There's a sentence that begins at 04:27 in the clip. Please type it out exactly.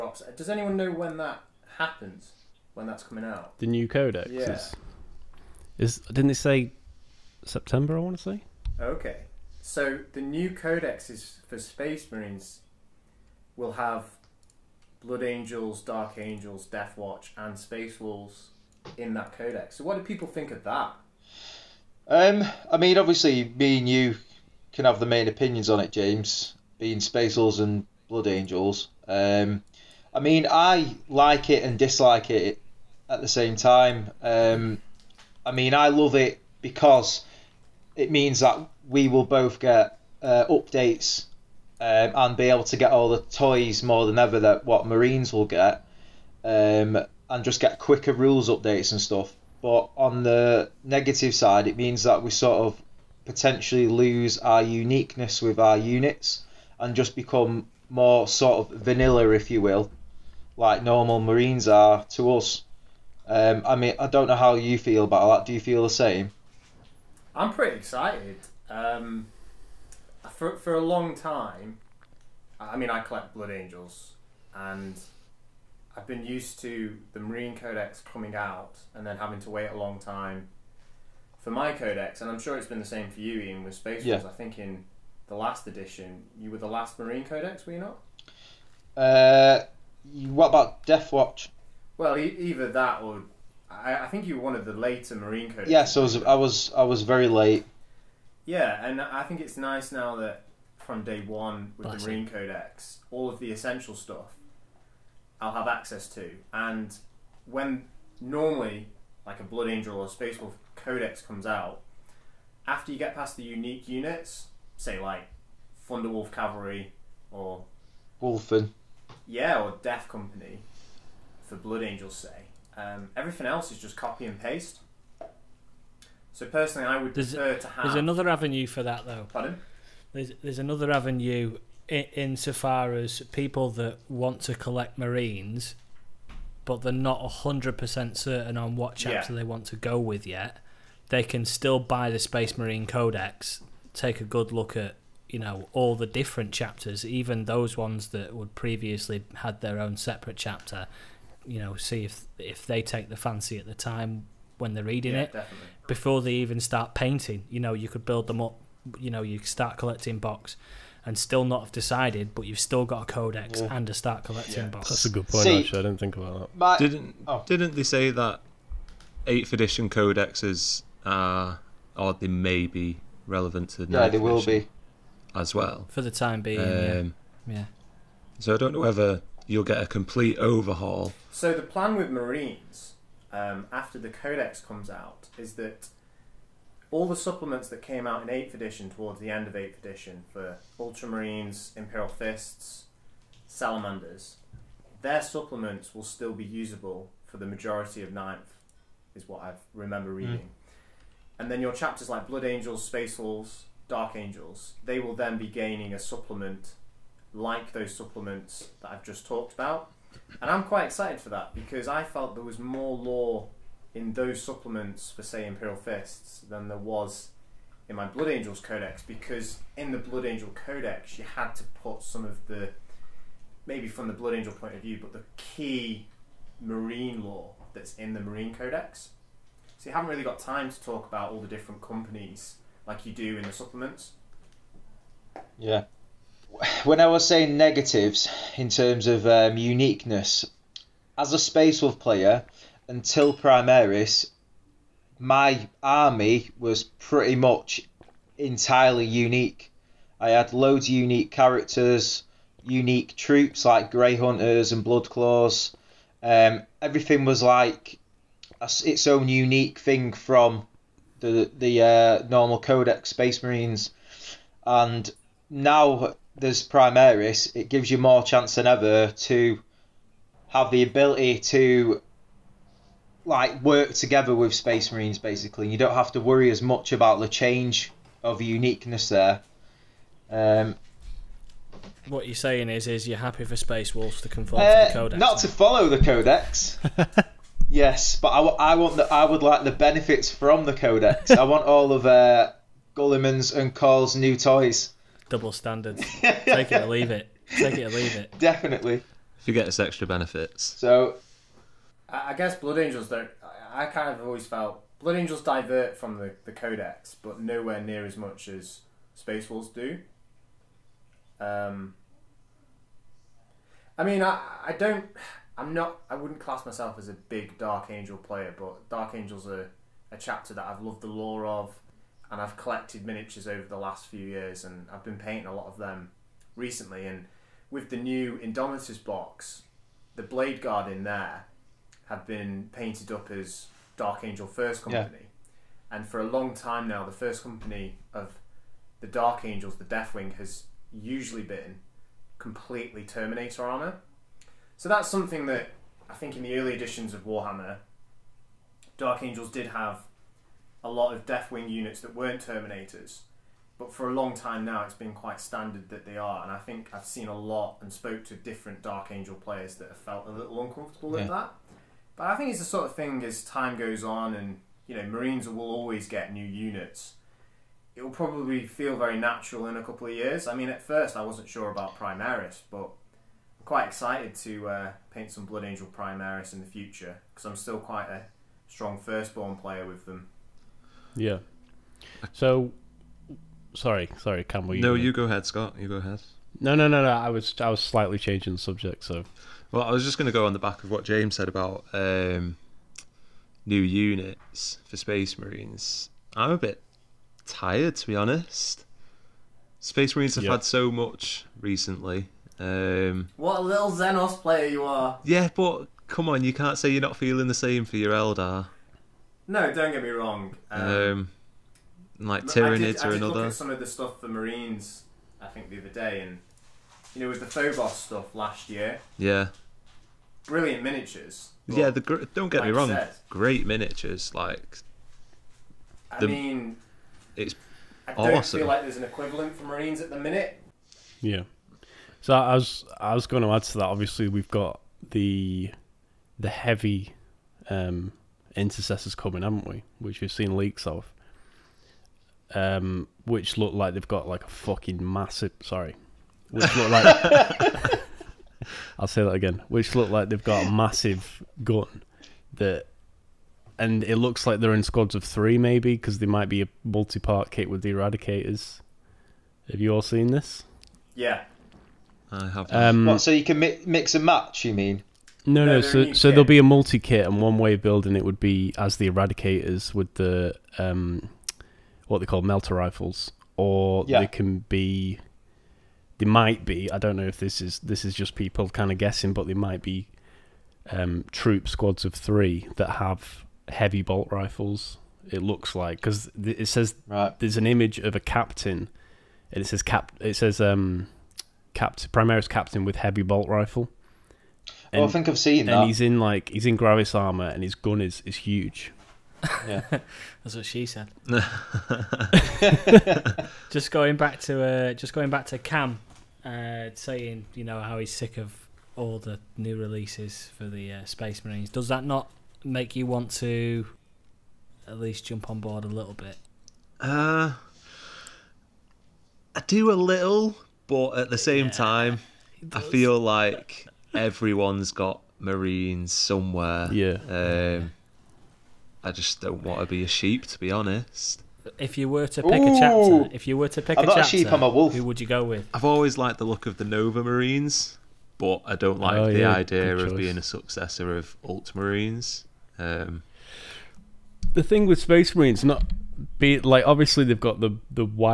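It gives you more chance than ever to have the ability to like work together with Space Marines basically.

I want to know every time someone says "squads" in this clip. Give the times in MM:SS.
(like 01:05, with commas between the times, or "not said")
07:34, 08:01.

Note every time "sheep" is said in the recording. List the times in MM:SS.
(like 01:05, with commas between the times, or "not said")
08:50, 08:54.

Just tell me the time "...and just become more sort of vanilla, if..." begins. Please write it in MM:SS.
00:56.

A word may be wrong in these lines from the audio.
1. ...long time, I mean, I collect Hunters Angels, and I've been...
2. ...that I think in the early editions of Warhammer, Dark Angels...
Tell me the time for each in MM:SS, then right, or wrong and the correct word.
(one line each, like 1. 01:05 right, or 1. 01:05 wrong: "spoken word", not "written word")
1. 01:10 wrong: "Blood", not "Hunters"
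2. 05:45 right.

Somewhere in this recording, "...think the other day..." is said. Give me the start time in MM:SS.
06:55.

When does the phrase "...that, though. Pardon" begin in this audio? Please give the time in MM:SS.
02:08.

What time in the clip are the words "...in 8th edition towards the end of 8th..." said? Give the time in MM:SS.
03:08.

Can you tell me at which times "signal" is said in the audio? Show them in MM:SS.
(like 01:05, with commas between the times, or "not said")
not said.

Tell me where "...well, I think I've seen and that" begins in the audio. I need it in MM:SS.
08:15.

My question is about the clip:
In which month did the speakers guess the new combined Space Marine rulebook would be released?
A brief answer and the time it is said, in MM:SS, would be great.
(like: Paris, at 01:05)
September, at 00:07.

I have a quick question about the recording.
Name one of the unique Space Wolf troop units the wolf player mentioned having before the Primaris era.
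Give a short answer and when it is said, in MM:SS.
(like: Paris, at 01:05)
Grey Hunters, at 04:13.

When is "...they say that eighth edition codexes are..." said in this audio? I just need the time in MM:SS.
02:47.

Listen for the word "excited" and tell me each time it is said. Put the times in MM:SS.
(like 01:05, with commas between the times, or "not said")
01:07, 03:30, 06:13.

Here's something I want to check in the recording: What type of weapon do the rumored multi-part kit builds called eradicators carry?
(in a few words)
melter rifles.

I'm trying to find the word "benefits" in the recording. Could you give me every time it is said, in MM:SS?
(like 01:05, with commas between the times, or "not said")
04:49, 05:00.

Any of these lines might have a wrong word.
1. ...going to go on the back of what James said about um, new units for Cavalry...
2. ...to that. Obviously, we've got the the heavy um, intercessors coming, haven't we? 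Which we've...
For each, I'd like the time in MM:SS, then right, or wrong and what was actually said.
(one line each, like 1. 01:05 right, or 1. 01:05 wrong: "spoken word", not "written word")
1. 06:30 wrong: "Space", not "Cavalry"
2. 07:13 right.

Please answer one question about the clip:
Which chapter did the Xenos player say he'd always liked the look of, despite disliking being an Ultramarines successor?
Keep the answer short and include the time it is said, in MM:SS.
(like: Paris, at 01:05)
Nova Marines, at 08:56.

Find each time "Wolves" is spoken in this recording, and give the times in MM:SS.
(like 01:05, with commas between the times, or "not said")
00:18, 01:24, 03:23, 04:43, 05:09.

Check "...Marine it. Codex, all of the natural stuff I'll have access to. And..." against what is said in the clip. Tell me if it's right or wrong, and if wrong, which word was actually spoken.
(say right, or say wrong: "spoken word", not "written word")
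wrong: "essential", not "natural".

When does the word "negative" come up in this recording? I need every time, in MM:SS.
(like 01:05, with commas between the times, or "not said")
00:50, 03:57.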